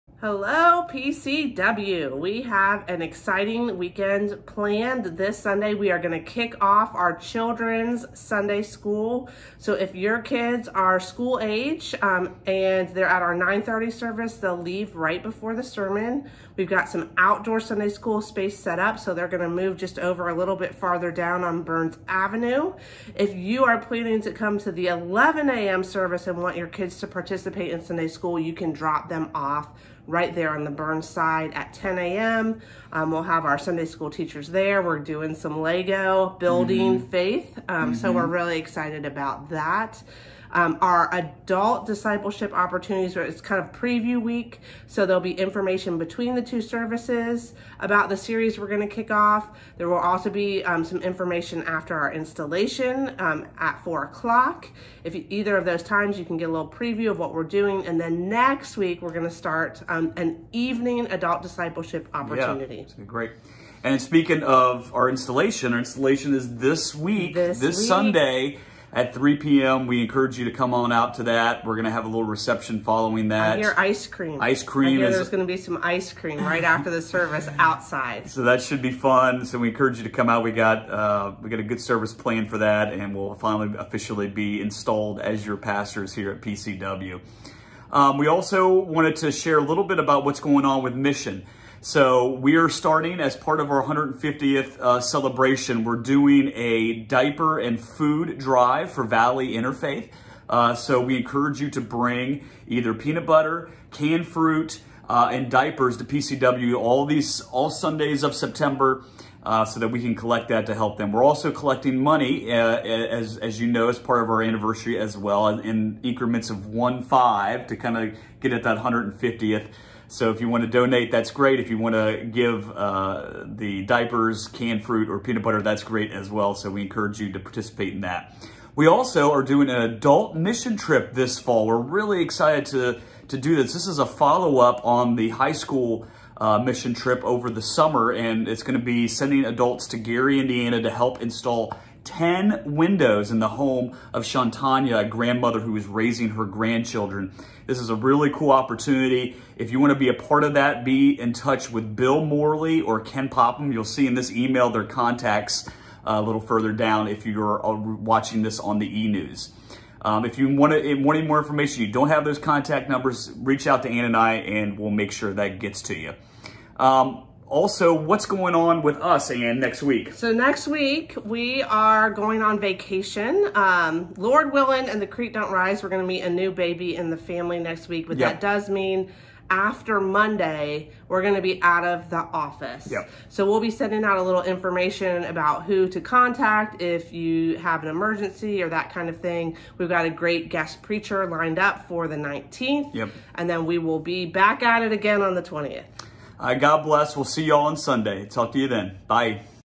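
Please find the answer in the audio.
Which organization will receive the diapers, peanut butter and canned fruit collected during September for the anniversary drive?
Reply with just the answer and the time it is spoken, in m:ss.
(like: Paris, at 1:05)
Valley Interfaith, at 1:39.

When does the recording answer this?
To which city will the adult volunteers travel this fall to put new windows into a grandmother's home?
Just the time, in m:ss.
2:19.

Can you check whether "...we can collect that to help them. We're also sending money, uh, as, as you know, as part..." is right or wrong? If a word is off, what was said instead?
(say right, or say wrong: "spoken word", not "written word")
wrong: "collecting", not "sending".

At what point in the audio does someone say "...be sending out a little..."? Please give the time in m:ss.
3:03.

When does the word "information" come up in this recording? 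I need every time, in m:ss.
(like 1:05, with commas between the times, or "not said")
0:45, 0:51, 2:41, 3:04.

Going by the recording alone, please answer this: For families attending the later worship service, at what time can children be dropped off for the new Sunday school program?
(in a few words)
10 a.m.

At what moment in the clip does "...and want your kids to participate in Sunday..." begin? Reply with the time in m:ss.
0:26.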